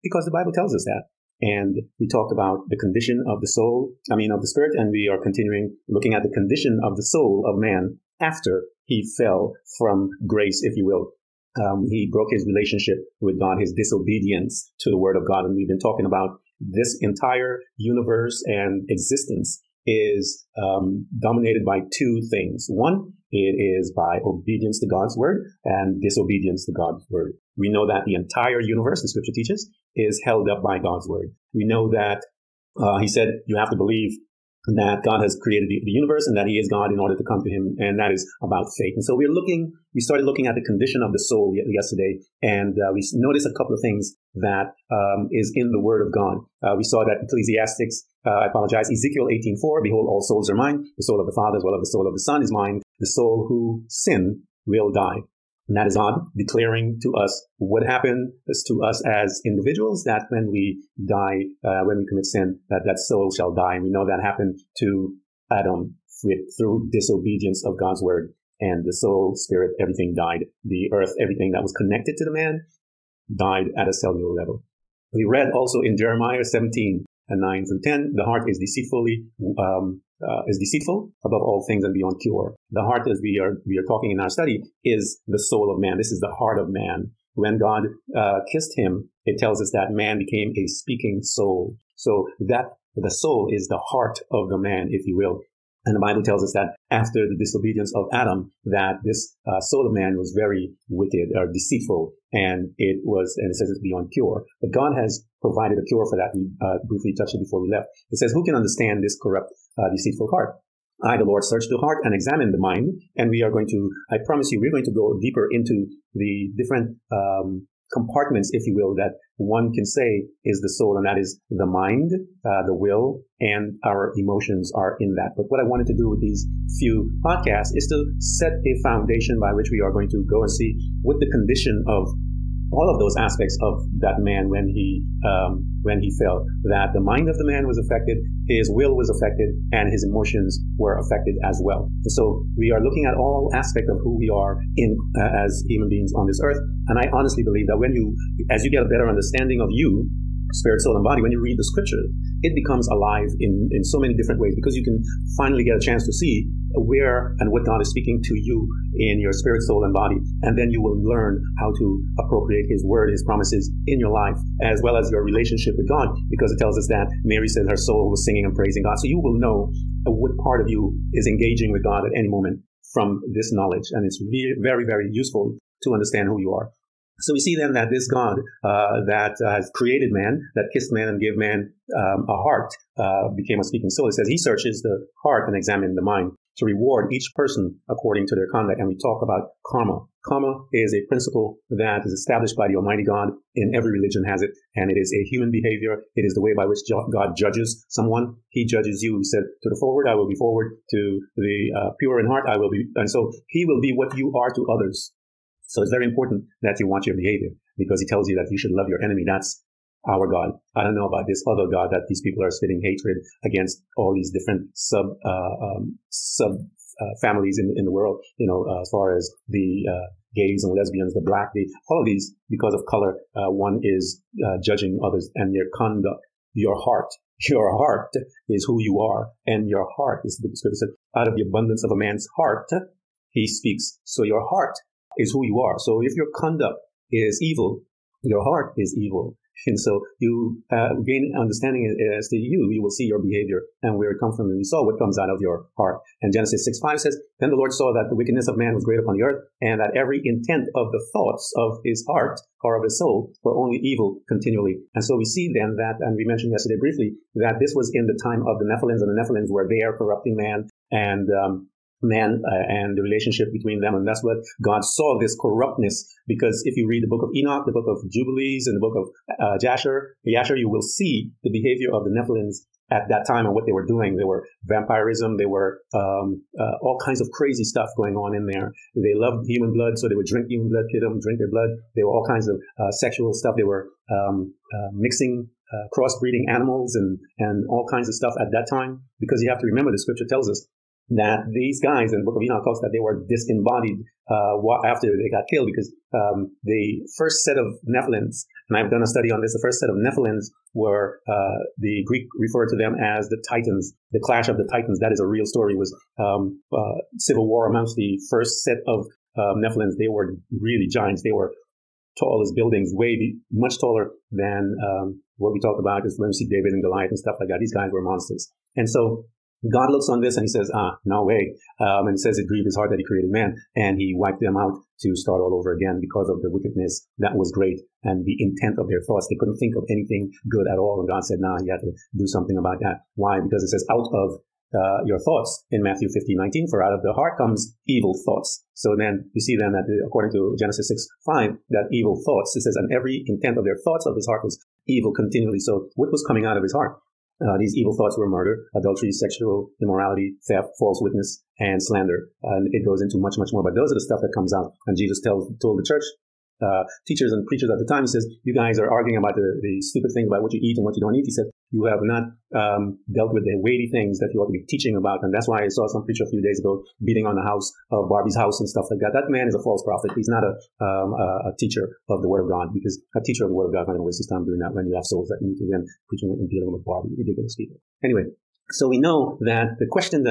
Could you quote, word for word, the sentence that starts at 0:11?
Um, he broke his relationship with God, his disobedience to the word of God.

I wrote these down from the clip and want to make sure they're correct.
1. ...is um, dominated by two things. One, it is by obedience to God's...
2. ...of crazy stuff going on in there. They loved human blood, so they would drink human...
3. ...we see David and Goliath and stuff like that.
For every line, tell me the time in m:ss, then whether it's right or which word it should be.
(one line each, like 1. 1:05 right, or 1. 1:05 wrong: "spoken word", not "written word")
1. 0:19 right
2. 4:37 right
3. 5:16 right.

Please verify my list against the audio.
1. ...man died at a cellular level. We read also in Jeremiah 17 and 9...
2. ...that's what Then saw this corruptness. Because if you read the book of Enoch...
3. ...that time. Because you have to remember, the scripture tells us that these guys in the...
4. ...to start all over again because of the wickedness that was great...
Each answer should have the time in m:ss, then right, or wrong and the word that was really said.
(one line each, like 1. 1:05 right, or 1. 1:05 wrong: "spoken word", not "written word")
1. 1:12 right
2. 4:24 wrong: "God", not "Then"
3. 4:48 right
4. 5:25 right.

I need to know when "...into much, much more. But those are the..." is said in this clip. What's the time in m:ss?
5:53.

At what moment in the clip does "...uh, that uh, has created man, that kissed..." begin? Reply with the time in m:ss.
2:58.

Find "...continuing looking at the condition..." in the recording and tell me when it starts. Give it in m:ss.
0:05.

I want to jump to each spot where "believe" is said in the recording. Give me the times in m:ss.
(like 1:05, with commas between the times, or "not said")
0:33, 2:27.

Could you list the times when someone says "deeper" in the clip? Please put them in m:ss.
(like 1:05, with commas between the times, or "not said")
1:55.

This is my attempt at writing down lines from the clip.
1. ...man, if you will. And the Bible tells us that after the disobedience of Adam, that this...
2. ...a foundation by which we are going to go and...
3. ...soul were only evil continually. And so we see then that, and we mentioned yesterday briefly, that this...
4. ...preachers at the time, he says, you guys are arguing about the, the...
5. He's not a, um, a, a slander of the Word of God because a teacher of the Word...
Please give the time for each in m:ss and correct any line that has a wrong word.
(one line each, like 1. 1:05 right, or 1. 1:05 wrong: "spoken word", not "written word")
1. 1:34 right
2. 2:08 right
3. 4:12 right
4. 5:57 right
5. 6:10 wrong: "teacher", not "slander".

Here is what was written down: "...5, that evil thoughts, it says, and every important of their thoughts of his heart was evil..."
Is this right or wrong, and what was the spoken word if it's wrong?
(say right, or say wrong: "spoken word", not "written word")
wrong: "intent", not "important".